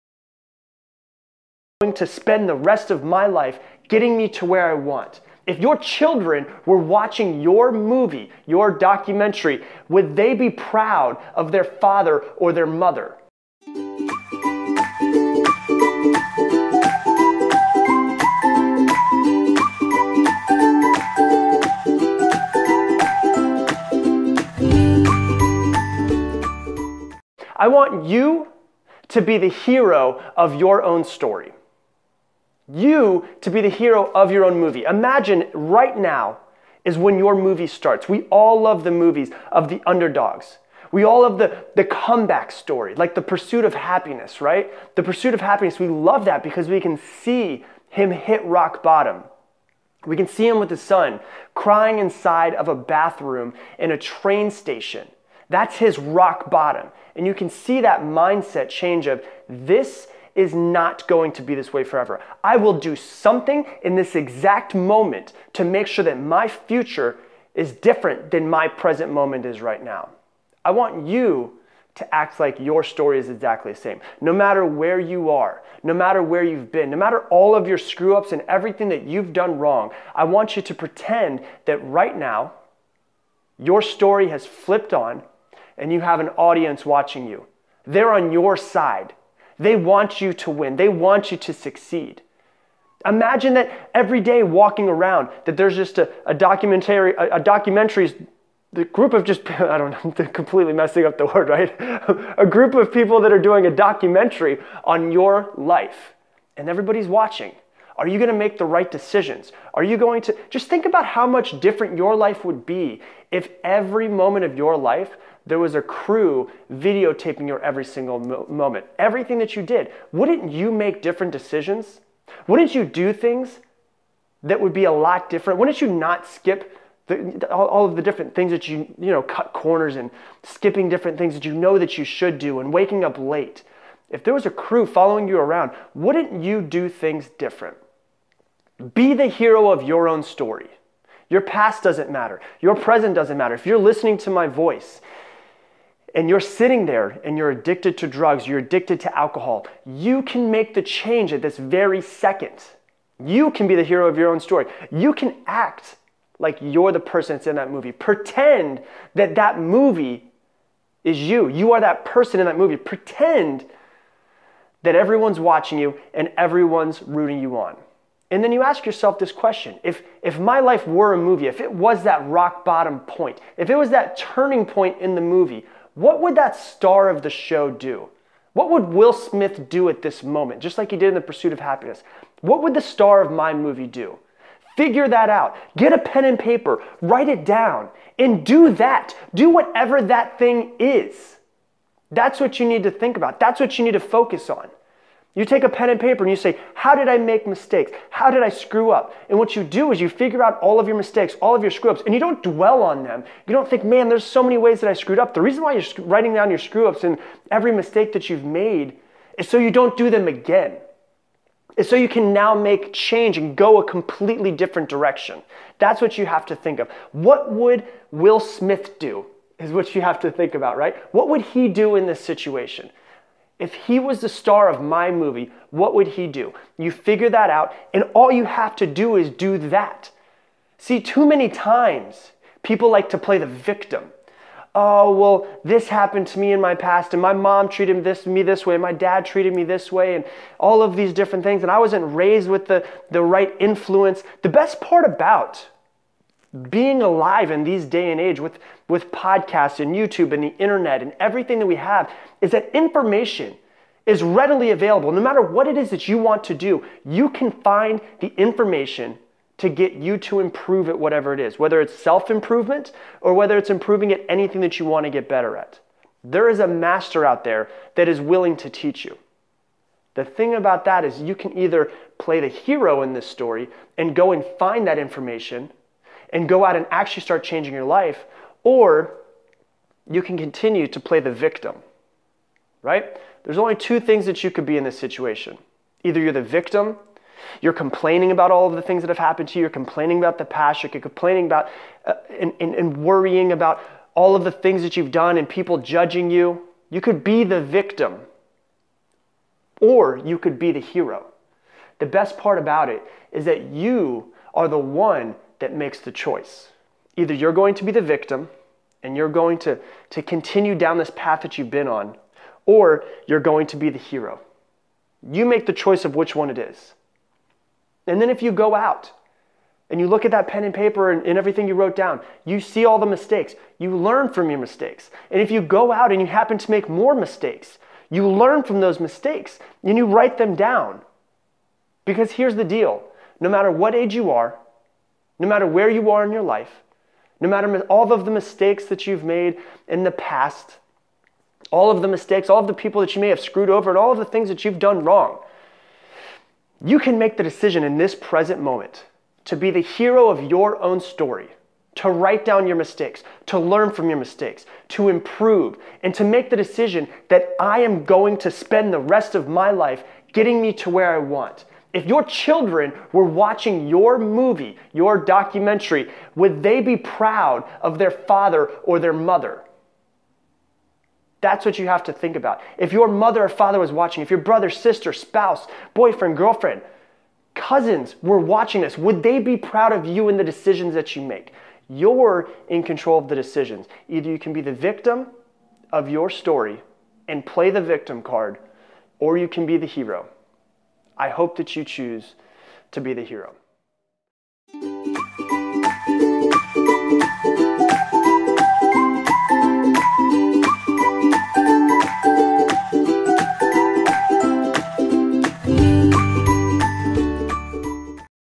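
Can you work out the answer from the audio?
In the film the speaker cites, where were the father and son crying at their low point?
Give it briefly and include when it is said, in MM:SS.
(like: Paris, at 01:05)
bathroom in a train station, at 00:52.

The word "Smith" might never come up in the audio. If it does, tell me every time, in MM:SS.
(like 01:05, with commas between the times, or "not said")
02:59, 03:38.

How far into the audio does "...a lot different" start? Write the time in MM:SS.
02:04.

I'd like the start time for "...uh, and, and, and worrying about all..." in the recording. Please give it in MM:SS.
04:52.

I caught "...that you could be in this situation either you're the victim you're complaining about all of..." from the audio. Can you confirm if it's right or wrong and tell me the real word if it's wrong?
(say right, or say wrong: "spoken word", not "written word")
right.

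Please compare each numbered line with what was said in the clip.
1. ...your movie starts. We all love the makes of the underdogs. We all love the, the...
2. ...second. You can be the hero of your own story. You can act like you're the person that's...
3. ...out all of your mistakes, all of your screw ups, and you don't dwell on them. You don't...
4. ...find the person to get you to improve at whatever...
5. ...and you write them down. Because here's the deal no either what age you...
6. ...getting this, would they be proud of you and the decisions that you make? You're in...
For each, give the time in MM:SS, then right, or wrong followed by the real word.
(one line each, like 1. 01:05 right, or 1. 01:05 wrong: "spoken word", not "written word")
1. 00:37 wrong: "movies", not "makes"
2. 02:32 right
3. 03:20 right
4. 04:17 wrong: "information", not "person"
5. 05:29 wrong: "matter", not "either"
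6. 06:18 wrong: "watching", not "getting".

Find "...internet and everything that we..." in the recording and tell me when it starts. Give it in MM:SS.
04:10.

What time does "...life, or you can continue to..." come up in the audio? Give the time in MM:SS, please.
04:37.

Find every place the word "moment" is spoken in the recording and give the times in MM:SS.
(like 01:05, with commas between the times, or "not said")
01:04, 01:09, 01:54, 01:58, 03:00, 05:48.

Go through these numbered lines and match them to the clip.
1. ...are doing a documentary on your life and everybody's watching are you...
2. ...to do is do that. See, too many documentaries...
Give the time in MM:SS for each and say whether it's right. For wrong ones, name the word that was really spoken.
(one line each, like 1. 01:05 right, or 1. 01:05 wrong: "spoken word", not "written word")
1. 01:43 right
2. 03:48 wrong: "times", not "documentaries".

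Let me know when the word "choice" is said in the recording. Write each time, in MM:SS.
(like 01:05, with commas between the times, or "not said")
05:06, 05:15.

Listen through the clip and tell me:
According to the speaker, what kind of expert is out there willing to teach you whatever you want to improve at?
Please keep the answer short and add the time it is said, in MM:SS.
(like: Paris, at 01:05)
a master, at 04:26.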